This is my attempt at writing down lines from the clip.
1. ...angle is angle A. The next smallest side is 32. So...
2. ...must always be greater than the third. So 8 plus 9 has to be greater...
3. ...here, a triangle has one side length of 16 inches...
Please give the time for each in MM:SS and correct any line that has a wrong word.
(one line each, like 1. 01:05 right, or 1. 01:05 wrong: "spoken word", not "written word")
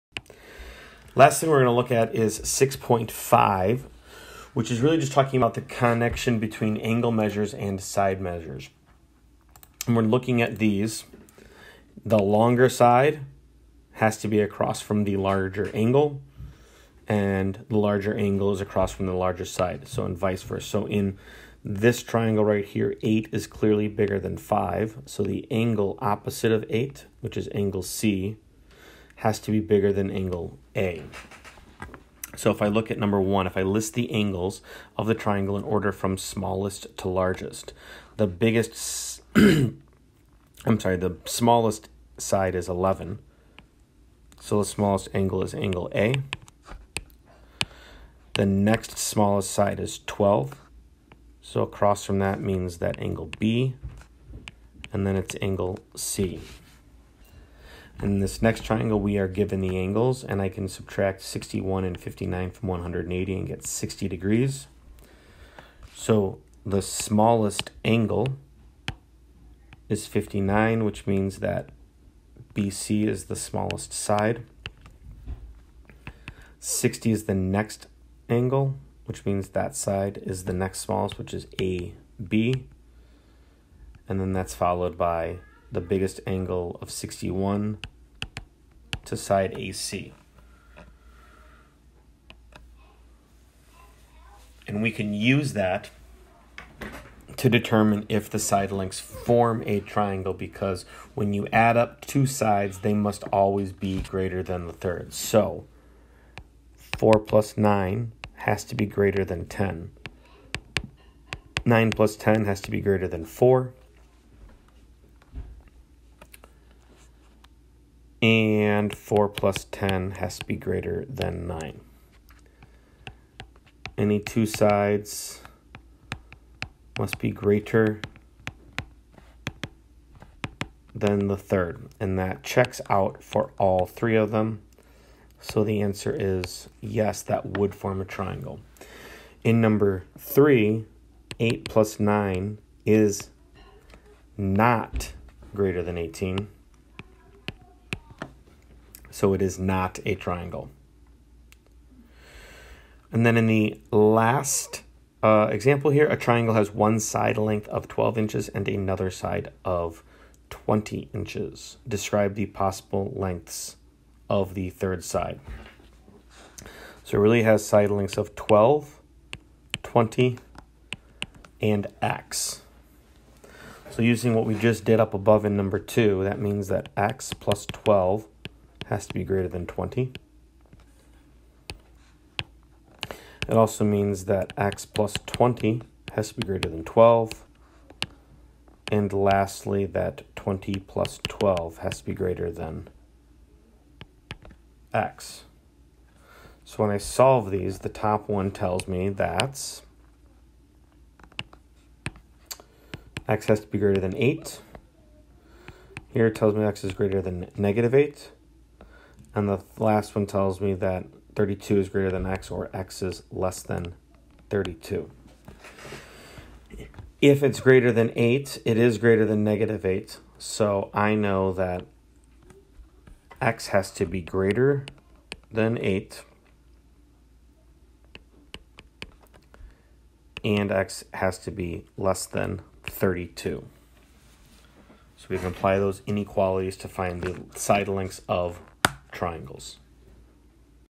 1. 00:45 wrong: "12", not "32"
2. 01:42 wrong: "4", not "8"
3. 02:35 wrong: "12", not "16".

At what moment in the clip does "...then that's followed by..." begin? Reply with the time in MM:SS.
01:24.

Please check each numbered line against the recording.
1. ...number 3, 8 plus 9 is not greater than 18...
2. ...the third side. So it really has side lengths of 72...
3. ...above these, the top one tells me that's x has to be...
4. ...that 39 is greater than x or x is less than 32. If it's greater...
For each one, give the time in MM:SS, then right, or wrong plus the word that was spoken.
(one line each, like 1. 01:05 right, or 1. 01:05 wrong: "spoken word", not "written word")
1. 02:19 right
2. 02:44 wrong: "12", not "72"
3. 03:16 wrong: "solve", not "above"
4. 03:30 wrong: "32", not "39".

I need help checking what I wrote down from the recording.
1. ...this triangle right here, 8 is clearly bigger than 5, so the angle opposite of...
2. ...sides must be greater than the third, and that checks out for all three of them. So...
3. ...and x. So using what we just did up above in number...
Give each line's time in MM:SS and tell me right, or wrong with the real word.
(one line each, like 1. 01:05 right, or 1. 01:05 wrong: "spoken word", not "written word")
1. 00:21 right
2. 02:04 right
3. 02:51 right.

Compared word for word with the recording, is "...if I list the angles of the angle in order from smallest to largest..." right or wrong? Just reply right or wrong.
wrong.